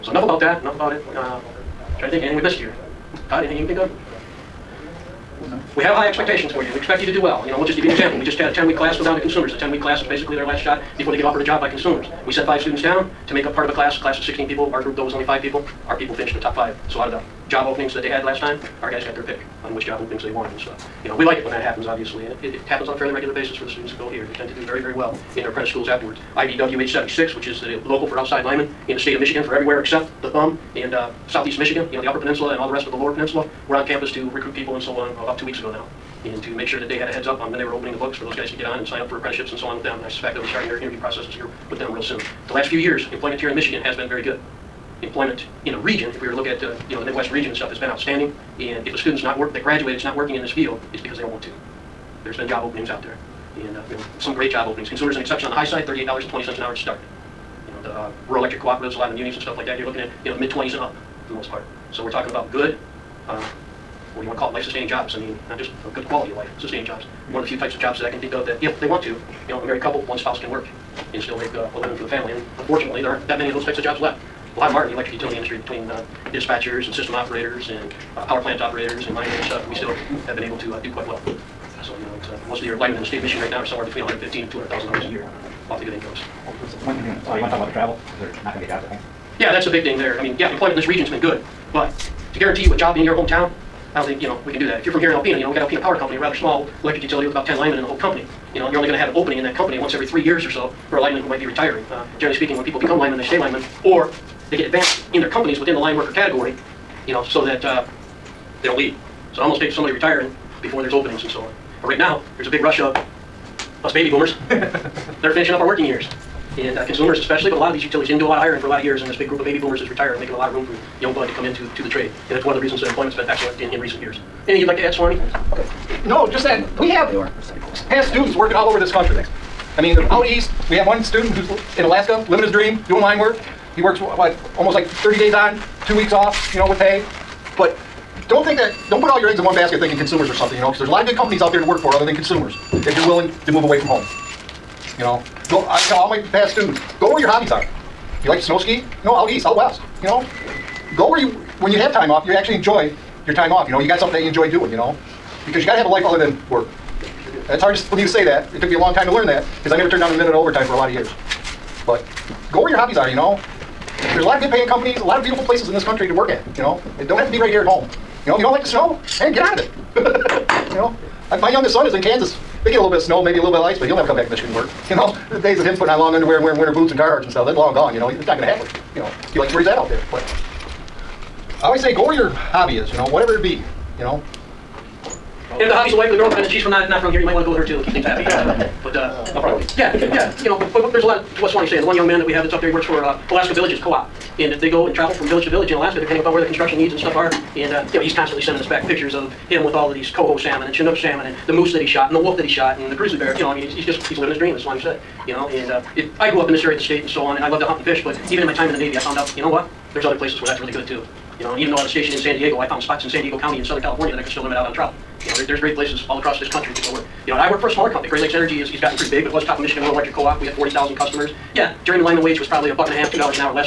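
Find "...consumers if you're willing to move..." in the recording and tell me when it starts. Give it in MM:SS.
02:22.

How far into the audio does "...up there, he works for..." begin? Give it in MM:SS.
03:12.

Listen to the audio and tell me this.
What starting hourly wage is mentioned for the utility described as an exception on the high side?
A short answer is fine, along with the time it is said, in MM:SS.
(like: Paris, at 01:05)
$38.20, at 00:55.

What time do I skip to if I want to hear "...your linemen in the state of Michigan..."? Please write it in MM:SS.
01:22.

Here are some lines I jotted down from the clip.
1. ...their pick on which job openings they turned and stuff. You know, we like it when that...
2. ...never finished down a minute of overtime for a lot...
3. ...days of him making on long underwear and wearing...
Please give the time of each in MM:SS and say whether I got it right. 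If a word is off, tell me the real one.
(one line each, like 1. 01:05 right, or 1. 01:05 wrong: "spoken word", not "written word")
1. 00:19 wrong: "wanted", not "turned"
2. 02:39 wrong: "turned", not "finished"
3. 02:55 wrong: "putting", not "making".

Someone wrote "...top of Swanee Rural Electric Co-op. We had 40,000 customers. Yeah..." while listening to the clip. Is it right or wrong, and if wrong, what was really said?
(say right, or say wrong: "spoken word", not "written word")
wrong: "Michigan", not "Swanee".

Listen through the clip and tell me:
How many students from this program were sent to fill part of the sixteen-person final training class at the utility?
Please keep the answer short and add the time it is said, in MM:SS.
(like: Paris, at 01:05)
5, at 00:12.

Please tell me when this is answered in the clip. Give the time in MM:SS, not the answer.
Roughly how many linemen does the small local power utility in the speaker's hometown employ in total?
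01:37.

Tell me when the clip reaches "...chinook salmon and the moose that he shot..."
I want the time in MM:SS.
03:20.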